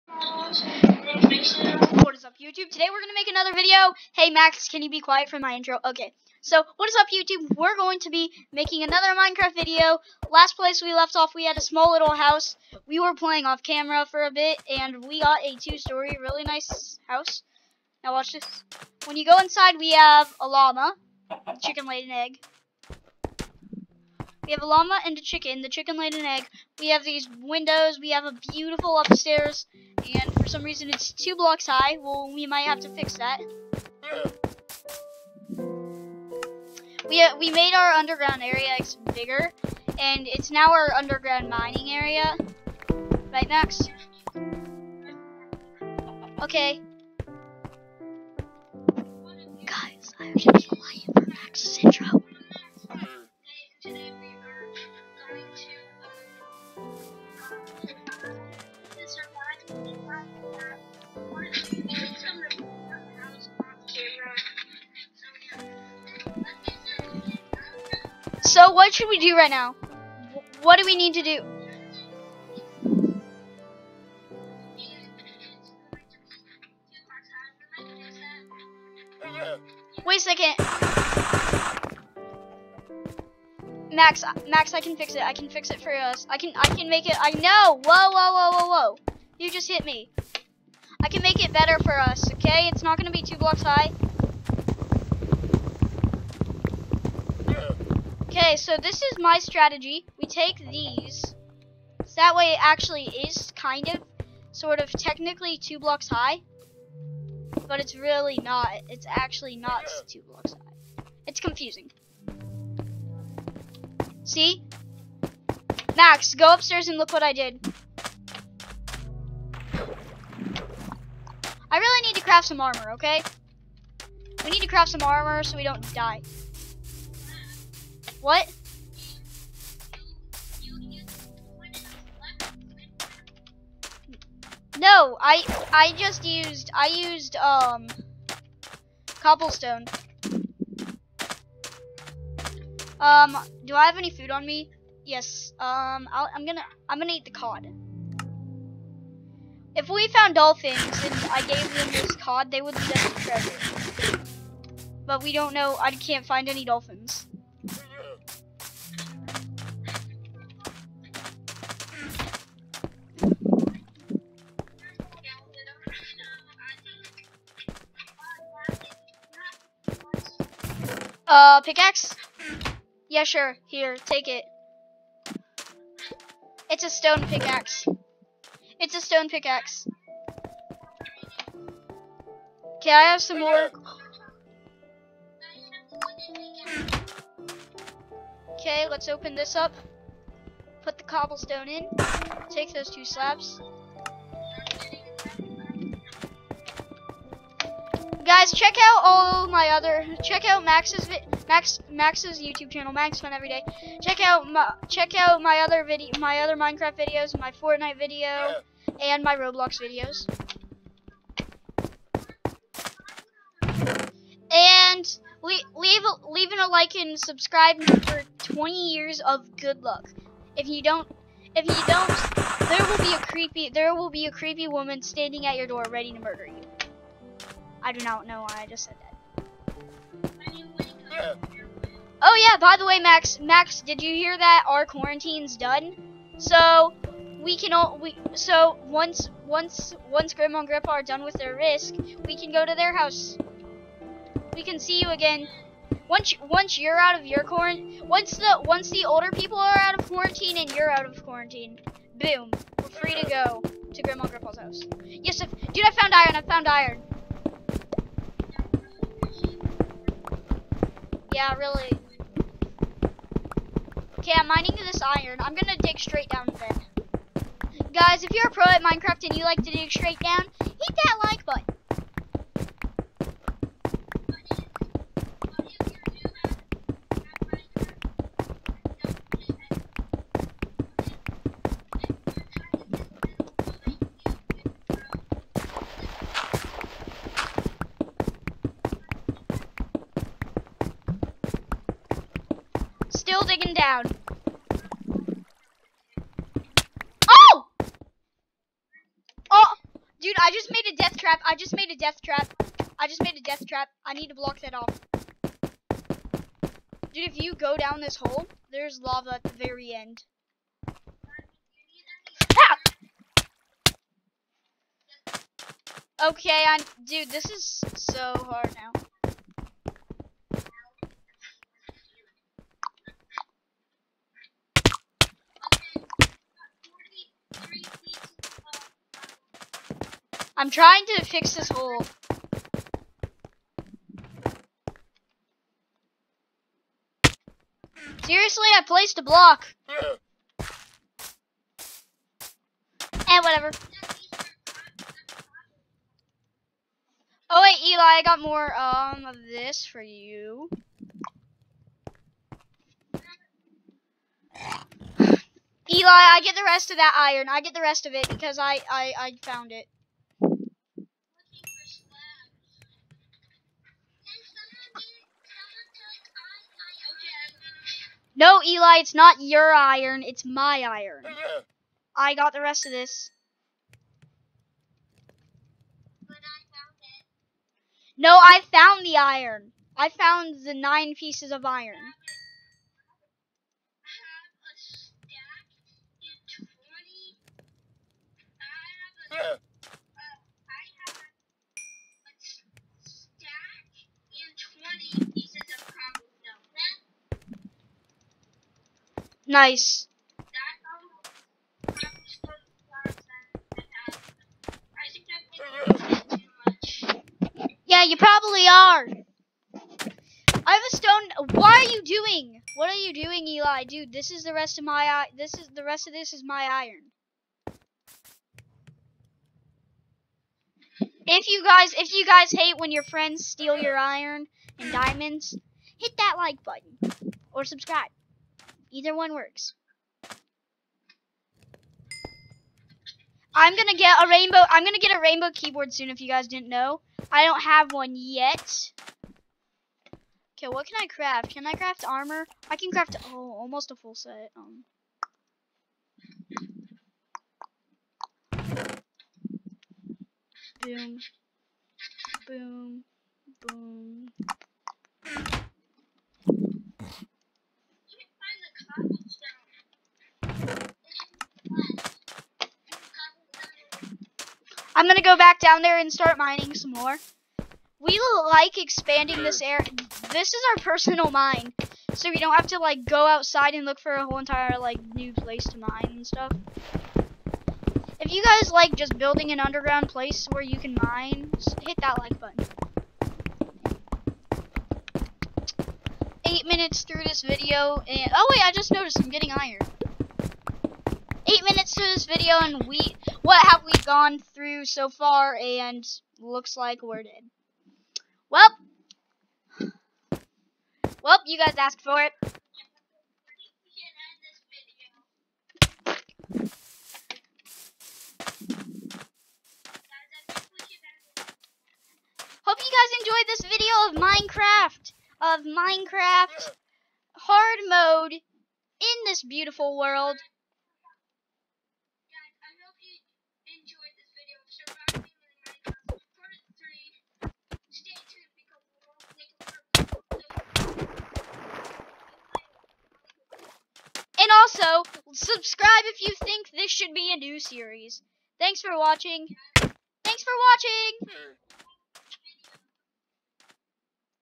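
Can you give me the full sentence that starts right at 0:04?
Hey, Max, can you be quiet for my intro?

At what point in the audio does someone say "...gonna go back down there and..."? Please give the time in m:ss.
7:45.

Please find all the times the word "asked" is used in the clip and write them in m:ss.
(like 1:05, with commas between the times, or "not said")
8:21.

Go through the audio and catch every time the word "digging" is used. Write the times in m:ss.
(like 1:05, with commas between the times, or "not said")
4:53.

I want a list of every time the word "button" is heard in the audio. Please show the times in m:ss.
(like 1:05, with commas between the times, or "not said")
4:31, 7:06, 8:02.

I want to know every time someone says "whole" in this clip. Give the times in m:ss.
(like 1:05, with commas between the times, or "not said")
7:54.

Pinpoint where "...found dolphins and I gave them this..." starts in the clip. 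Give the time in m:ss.
2:30.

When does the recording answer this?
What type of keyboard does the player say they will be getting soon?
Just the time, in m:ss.
7:15.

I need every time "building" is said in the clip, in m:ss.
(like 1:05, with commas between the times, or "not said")
7:59.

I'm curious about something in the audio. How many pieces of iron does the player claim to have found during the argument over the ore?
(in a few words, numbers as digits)
9.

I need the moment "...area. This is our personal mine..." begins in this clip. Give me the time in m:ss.
7:49.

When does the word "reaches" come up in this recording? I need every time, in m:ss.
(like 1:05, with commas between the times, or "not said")
not said.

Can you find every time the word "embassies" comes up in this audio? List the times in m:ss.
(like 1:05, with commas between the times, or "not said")
not said.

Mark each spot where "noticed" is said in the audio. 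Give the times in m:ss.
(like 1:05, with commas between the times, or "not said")
8:08.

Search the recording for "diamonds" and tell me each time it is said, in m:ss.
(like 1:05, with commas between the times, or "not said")
7:04.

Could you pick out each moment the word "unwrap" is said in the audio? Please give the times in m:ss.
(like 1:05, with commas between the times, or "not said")
not said.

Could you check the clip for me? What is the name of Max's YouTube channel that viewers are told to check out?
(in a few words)
Max Fun Every Day.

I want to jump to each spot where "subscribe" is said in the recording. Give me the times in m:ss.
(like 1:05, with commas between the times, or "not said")
3:37, 7:07.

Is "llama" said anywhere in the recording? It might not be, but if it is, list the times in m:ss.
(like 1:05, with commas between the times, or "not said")
0:20, 0:24.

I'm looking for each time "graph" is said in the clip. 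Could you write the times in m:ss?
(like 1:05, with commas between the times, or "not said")
not said.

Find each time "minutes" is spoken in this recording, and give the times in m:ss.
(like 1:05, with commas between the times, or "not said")
8:06, 8:11.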